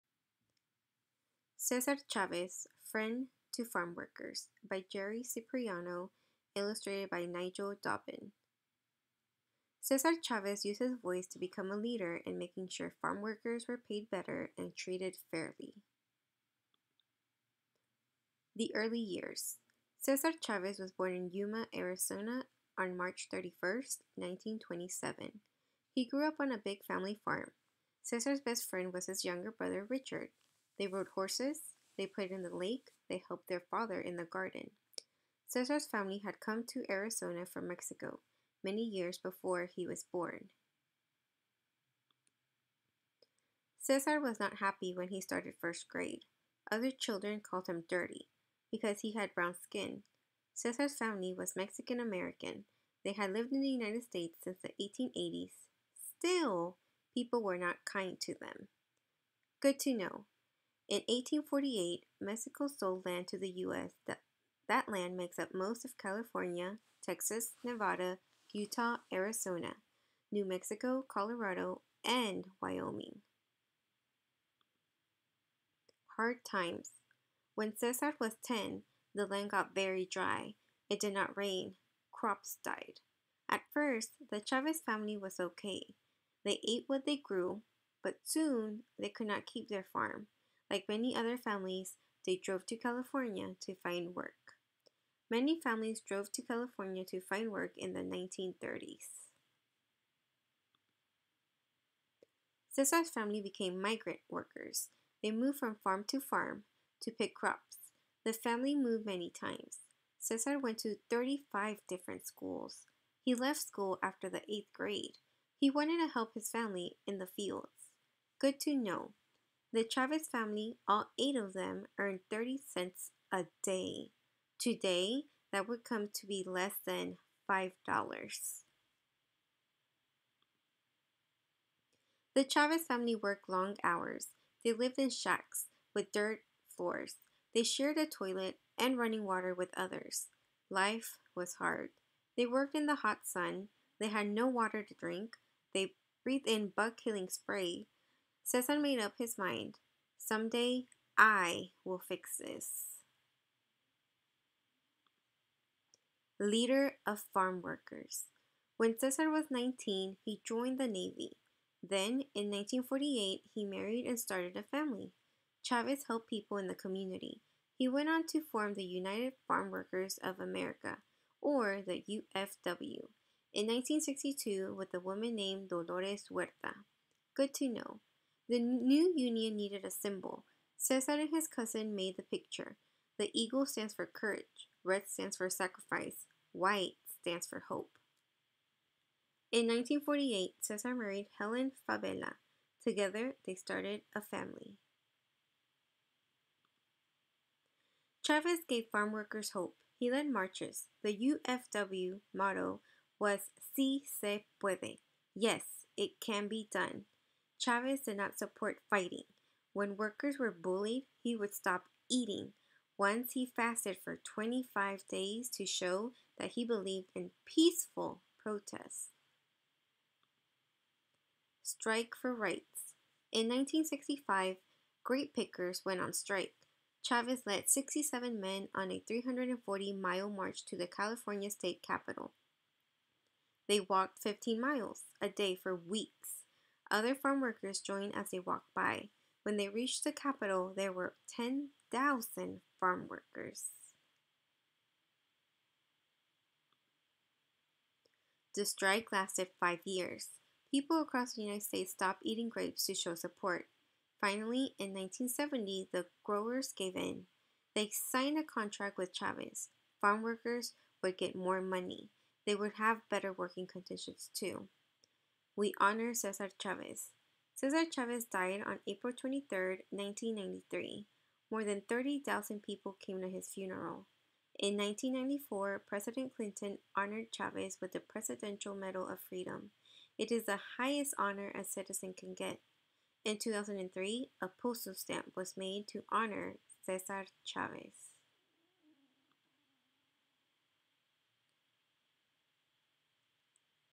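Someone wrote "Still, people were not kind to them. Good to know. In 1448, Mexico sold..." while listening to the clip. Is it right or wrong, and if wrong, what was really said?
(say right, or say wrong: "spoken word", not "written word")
wrong: "1848", not "1448".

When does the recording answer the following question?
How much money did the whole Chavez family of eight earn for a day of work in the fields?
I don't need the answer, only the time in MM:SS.
02:02.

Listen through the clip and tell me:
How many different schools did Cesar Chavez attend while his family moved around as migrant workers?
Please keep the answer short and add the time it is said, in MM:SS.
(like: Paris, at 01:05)
35, at 01:51.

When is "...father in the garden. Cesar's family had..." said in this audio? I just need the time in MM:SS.
00:33.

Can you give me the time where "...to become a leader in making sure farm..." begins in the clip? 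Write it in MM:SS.
00:11.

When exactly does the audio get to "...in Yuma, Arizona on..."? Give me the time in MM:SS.
00:21.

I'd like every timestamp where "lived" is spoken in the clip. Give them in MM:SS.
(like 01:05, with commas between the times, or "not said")
00:53, 02:14.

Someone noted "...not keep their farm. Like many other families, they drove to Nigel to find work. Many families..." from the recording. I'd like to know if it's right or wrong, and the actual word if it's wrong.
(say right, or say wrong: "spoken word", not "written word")
wrong: "California", not "Nigel".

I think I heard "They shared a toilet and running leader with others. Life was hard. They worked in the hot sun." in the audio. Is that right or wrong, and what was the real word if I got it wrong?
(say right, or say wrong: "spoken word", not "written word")
wrong: "water", not "leader".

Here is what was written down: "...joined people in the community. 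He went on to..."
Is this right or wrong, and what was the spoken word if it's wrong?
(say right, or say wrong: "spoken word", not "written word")
wrong: "helped", not "joined".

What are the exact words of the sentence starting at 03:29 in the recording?
When workers were bullied, he would stop eating.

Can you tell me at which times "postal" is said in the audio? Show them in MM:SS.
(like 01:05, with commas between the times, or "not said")
04:44.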